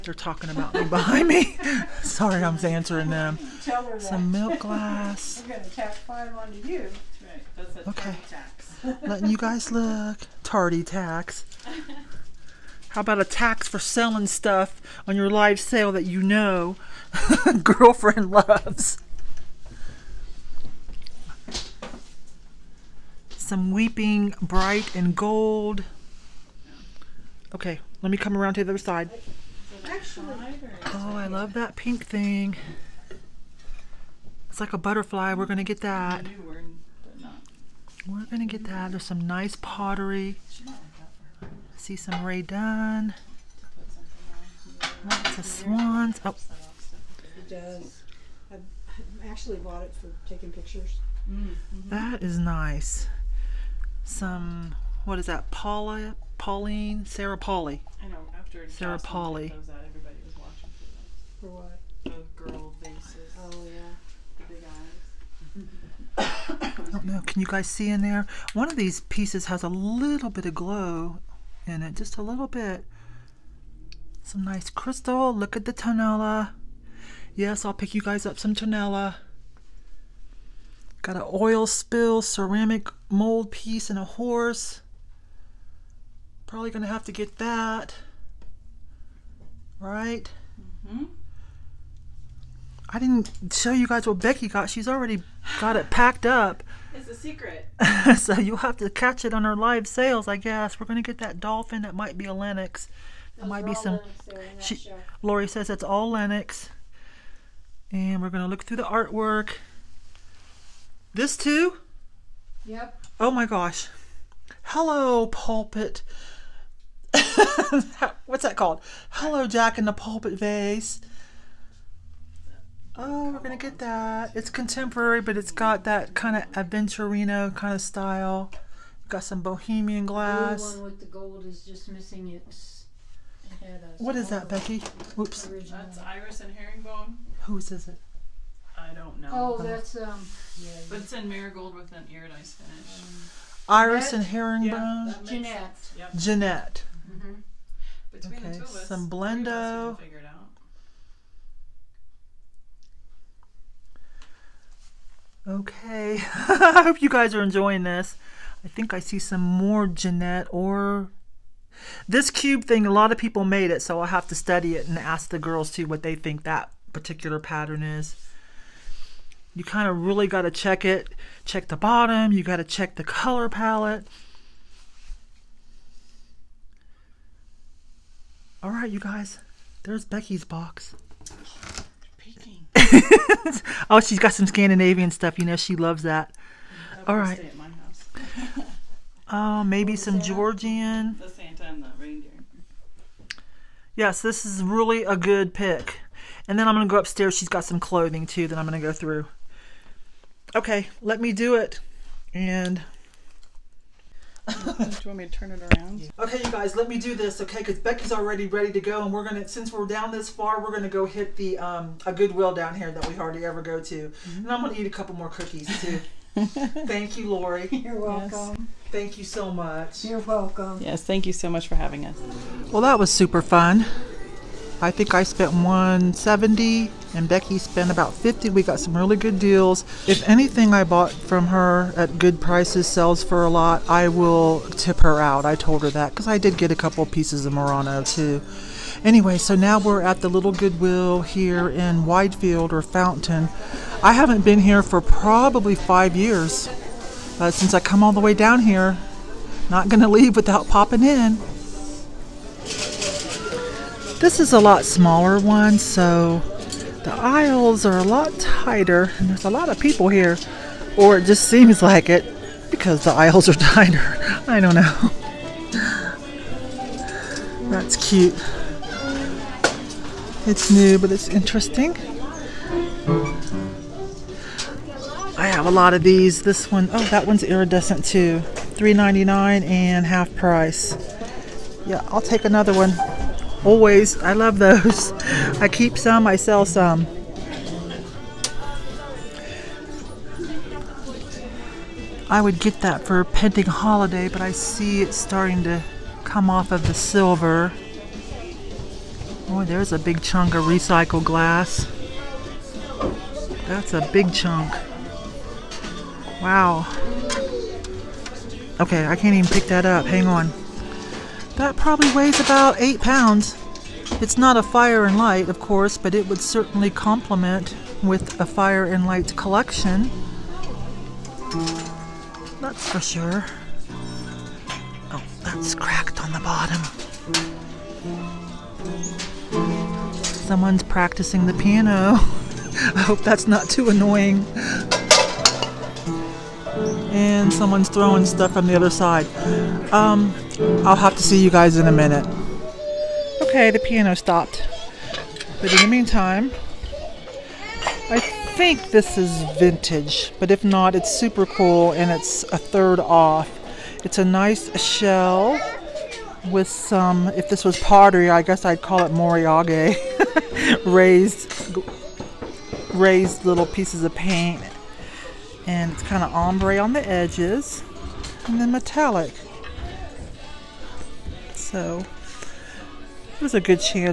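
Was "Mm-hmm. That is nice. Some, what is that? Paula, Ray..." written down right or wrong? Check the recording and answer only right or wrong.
wrong.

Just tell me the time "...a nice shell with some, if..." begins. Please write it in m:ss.
5:54.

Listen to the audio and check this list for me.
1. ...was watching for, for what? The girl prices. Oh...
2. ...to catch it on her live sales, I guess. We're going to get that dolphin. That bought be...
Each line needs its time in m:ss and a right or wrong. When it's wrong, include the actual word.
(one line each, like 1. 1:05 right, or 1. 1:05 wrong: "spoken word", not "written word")
1. 1:00 wrong: "vases", not "prices"
2. 1:38 wrong: "might", not "bought".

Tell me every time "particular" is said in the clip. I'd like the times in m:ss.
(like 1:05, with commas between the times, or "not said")
2:46.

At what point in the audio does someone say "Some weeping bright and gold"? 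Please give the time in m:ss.
0:23.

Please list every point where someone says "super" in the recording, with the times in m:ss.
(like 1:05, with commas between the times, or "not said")
3:43, 5:51.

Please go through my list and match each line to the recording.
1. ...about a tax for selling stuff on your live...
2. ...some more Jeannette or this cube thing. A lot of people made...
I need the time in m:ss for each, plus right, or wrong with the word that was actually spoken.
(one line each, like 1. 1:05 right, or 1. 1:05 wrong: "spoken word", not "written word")
1. 0:13 right
2. 2:39 right.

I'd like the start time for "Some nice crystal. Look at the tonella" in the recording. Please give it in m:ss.
1:14.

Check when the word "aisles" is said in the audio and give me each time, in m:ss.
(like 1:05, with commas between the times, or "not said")
4:17, 4:23.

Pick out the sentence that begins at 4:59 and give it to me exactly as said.
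Oh, there's a big chunk of recycled glass.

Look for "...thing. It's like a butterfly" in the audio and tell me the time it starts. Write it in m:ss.
0:32.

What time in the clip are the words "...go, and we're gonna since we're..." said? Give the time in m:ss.
3:28.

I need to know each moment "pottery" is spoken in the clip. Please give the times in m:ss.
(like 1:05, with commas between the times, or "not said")
0:39, 5:57.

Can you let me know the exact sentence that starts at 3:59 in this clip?
Anyway, so now we're at the little Goodwill here in Widefield or Fountain.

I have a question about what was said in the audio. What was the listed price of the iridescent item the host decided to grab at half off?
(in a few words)
$3.99.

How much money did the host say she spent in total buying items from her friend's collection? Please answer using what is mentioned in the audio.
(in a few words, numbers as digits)
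$170.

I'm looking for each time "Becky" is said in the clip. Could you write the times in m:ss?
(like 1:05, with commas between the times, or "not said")
1:34, 2:14, 3:00, 3:27, 3:47.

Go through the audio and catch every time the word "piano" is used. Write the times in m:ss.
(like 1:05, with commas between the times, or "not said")
5:31, 5:43.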